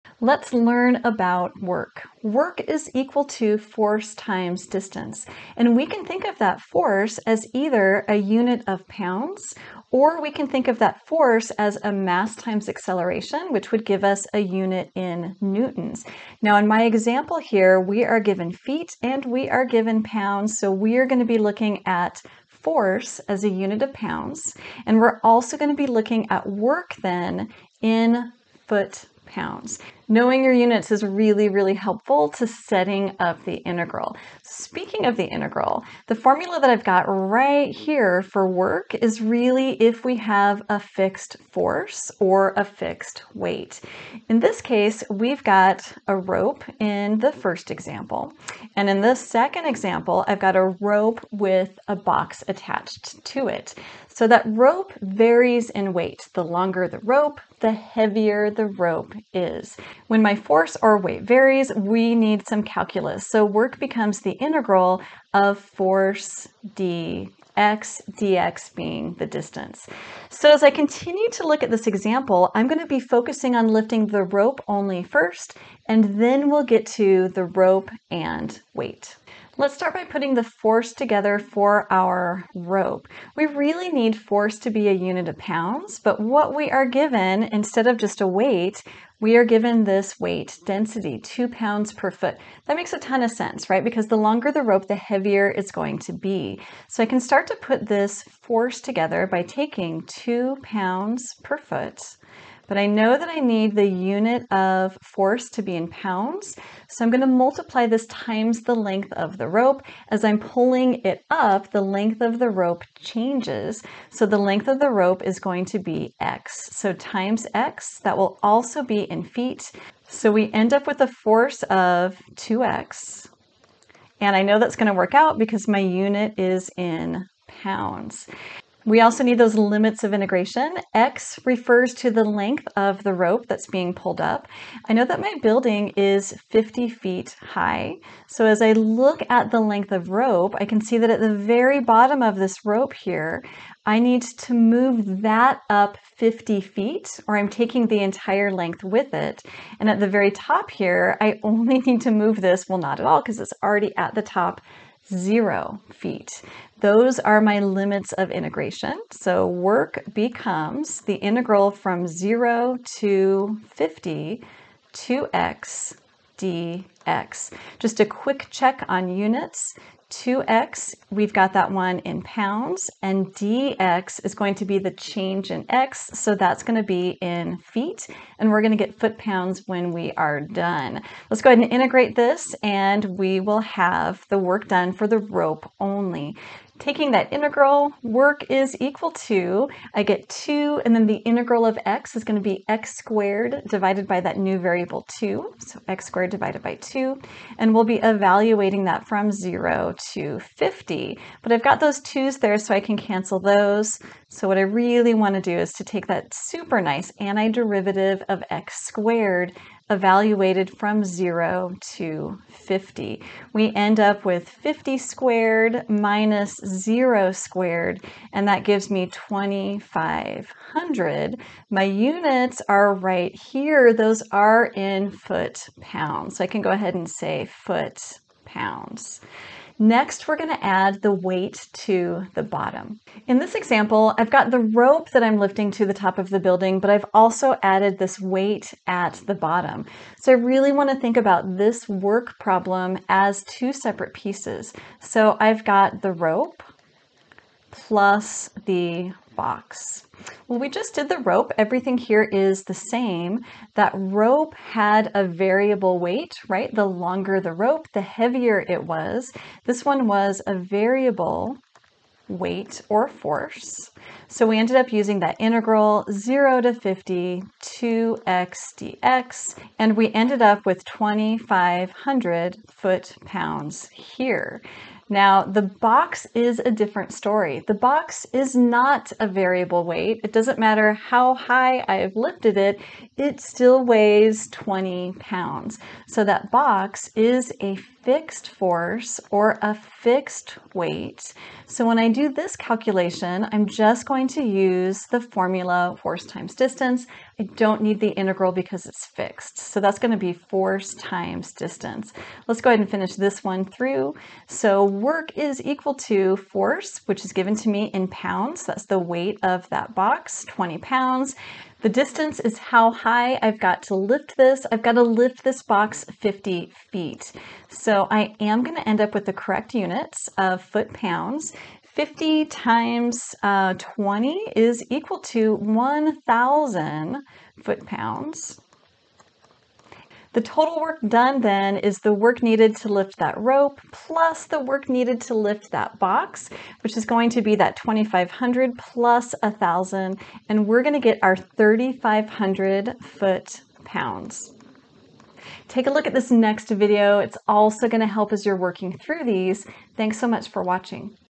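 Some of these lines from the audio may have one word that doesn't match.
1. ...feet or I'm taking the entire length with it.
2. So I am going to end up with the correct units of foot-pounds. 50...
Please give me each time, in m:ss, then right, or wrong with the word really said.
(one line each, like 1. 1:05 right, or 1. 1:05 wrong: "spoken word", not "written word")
1. 2:26 right
2. 5:17 right.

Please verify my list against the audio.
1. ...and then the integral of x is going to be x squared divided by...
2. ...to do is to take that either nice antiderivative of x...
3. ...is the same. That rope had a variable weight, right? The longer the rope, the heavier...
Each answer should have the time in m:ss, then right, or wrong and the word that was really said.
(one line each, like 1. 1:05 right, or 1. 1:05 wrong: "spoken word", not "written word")
1. 3:10 right
2. 3:25 wrong: "super", not "either"
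3. 4:12 right.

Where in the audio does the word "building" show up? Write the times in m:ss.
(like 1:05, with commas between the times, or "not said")
2:15, 3:56.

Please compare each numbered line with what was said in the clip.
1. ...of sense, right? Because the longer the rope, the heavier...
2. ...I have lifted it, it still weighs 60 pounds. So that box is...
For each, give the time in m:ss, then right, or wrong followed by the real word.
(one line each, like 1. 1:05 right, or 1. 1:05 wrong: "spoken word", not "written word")
1. 1:33 right
2. 4:41 wrong: "20", not "60".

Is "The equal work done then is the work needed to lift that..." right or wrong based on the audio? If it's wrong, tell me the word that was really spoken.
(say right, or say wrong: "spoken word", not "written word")
wrong: "total", not "equal".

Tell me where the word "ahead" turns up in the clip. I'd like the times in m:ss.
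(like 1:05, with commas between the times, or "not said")
3:01, 3:46, 5:02.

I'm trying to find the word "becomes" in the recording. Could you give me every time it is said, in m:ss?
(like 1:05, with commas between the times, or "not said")
1:03, 2:40.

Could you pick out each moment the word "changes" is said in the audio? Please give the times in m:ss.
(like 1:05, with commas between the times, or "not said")
1:52, 2:54.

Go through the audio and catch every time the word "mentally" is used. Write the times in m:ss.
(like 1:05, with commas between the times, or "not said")
not said.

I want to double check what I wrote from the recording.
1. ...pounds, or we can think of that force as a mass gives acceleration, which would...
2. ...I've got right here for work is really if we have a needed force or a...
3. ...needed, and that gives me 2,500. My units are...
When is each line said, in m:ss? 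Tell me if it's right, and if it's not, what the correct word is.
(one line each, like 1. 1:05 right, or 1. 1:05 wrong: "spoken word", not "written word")
1. 0:08 wrong: "times", not "gives"
2. 0:36 wrong: "fixed", not "needed"
3. 3:37 wrong: "squared", not "needed".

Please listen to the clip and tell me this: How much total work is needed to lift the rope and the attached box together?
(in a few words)
3,500 foot-pounds.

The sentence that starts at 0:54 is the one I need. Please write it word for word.
So that rope varies in weight.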